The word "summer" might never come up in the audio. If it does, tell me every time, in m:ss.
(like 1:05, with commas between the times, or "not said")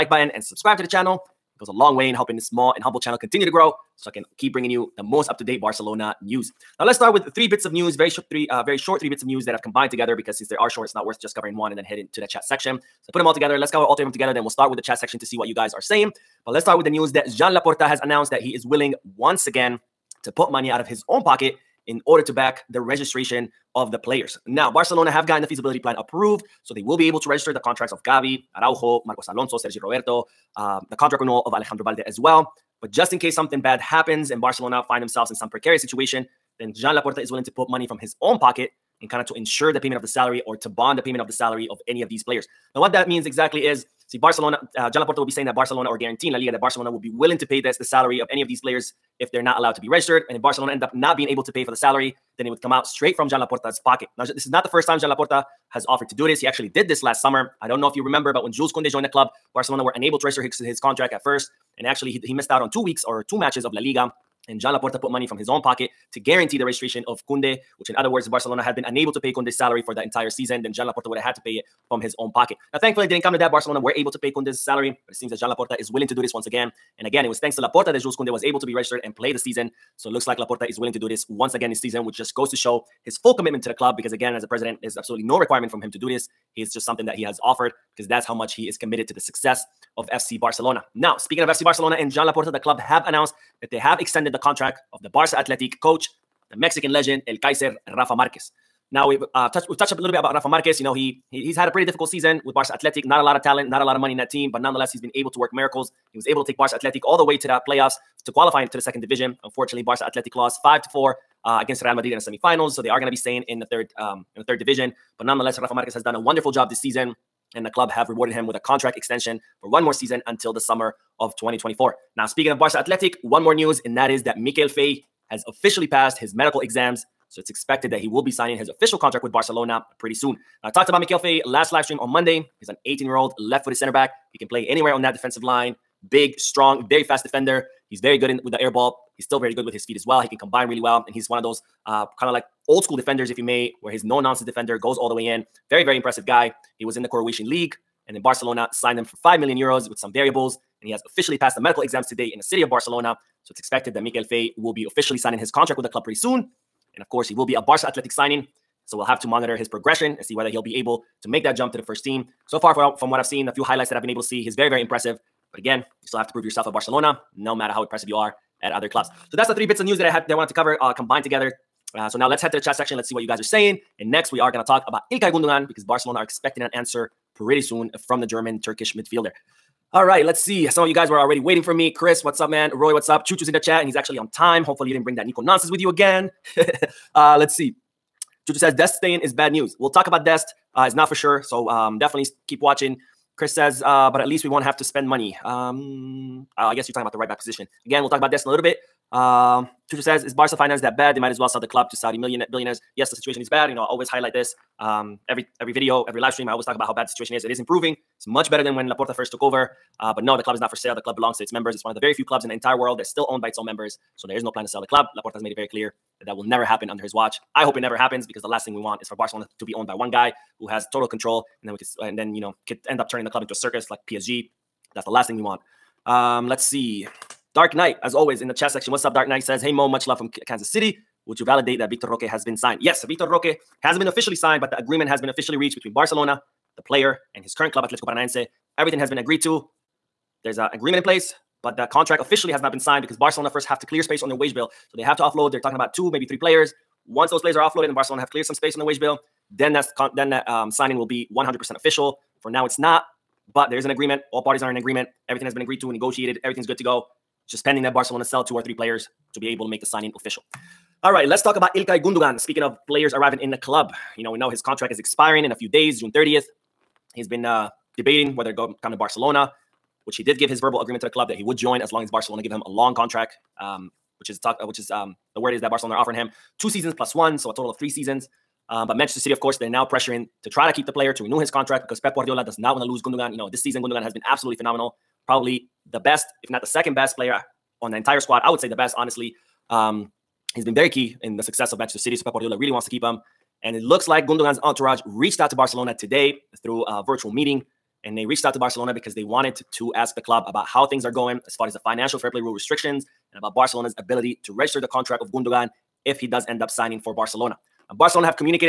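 0:57, 2:00.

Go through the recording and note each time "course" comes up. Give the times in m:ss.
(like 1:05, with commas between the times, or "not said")
2:37, 4:39.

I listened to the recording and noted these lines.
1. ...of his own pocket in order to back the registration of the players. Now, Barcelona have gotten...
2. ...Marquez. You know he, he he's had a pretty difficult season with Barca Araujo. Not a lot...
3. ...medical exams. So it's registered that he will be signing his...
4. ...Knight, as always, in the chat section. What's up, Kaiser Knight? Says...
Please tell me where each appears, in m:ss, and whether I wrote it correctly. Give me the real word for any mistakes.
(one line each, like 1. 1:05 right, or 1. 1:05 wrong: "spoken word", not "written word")
1. 0:20 right
2. 1:40 wrong: "Athletic", not "Araujo"
3. 2:06 wrong: "expected", not "registered"
4. 3:47 wrong: "Dark", not "Kaiser".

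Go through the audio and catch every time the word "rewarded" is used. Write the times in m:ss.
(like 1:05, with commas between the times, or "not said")
1:58.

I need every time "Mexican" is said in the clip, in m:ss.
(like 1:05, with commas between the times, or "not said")
1:36.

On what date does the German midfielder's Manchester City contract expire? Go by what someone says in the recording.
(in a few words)
June 30th.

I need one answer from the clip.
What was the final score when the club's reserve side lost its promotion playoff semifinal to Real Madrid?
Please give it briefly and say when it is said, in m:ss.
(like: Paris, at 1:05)
5-4, at 1:50.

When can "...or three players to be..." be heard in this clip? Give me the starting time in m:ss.
4:18.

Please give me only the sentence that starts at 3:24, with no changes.
Um, every every video, every live stream, I always talk about how bad the situation is.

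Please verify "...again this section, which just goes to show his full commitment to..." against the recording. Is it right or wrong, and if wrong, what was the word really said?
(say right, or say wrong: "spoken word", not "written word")
wrong: "season", not "section".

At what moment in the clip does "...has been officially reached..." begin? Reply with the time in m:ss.
3:55.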